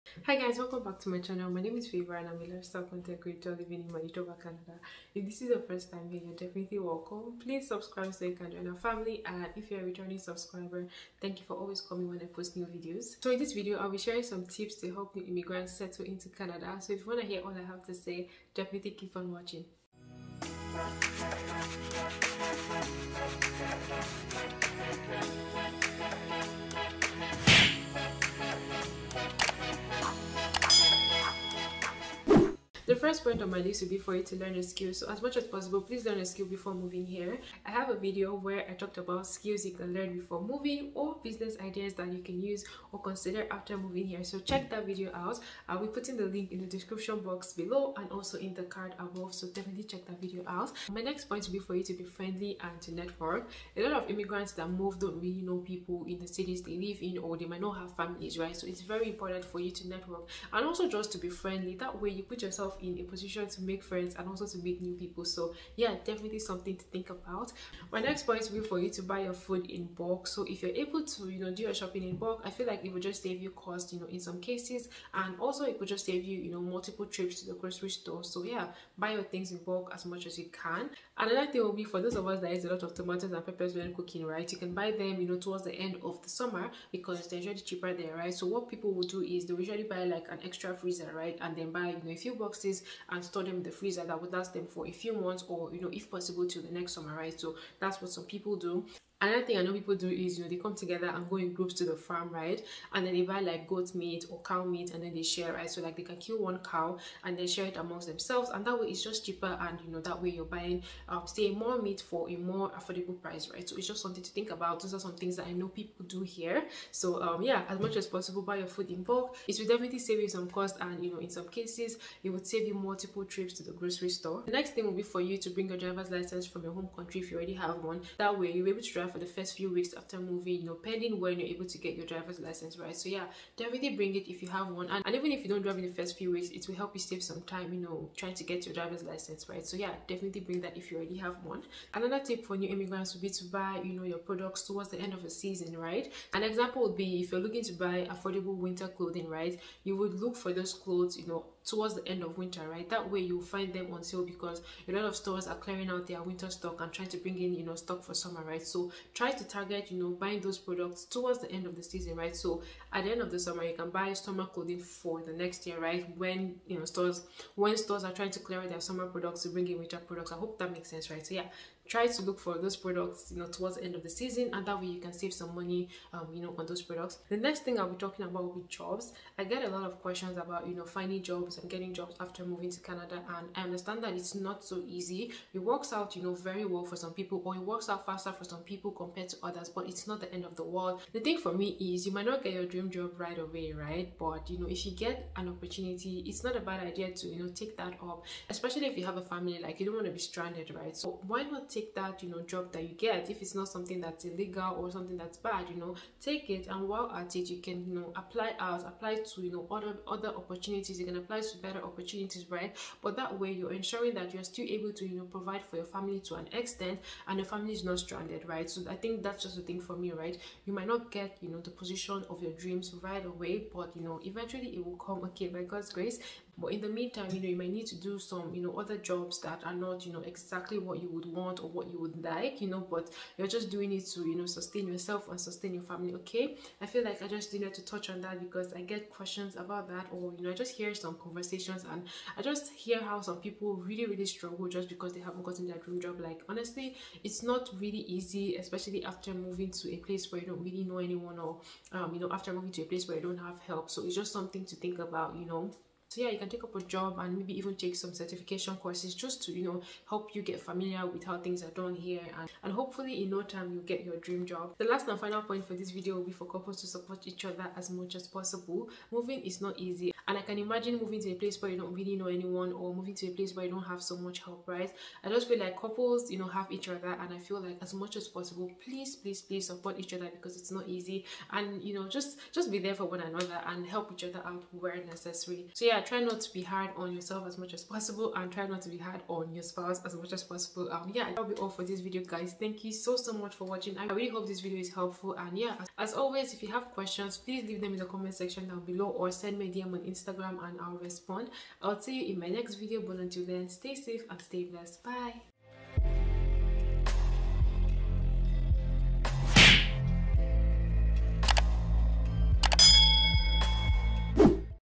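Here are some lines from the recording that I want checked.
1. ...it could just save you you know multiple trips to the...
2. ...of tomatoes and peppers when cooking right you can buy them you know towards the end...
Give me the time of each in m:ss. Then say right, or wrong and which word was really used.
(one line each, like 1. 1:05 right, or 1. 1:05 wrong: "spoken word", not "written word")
1. 1:15 right
2. 1:22 right.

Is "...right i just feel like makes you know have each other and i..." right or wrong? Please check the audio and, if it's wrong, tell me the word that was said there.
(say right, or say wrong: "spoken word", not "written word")
wrong: "couples", not "makes".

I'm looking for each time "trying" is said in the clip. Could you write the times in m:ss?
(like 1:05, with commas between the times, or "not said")
2:18, 2:36, 2:48.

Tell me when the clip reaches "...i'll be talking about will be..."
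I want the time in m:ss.
2:57.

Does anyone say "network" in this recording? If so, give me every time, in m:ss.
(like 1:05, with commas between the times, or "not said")
0:52, 0:59.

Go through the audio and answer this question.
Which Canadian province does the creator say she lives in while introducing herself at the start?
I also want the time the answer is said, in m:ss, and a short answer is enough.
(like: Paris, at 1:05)
Manitoba, at 0:03.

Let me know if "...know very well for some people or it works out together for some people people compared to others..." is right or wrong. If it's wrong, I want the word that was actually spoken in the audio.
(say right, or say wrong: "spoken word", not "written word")
wrong: "faster", not "together".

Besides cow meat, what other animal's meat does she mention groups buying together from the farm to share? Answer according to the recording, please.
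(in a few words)
Goat.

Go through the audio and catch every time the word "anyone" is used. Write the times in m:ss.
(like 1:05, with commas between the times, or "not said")
4:10, 4:32.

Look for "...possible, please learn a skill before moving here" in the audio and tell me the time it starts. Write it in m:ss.
0:35.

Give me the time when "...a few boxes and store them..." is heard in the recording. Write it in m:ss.
1:32.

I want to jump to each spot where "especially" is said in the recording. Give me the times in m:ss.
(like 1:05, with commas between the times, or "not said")
3:18, 4:08.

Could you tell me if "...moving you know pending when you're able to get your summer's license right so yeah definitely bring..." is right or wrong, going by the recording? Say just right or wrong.
wrong.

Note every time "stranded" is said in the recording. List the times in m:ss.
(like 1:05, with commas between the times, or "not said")
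3:20, 3:37.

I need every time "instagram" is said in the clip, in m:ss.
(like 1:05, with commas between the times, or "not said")
4:59.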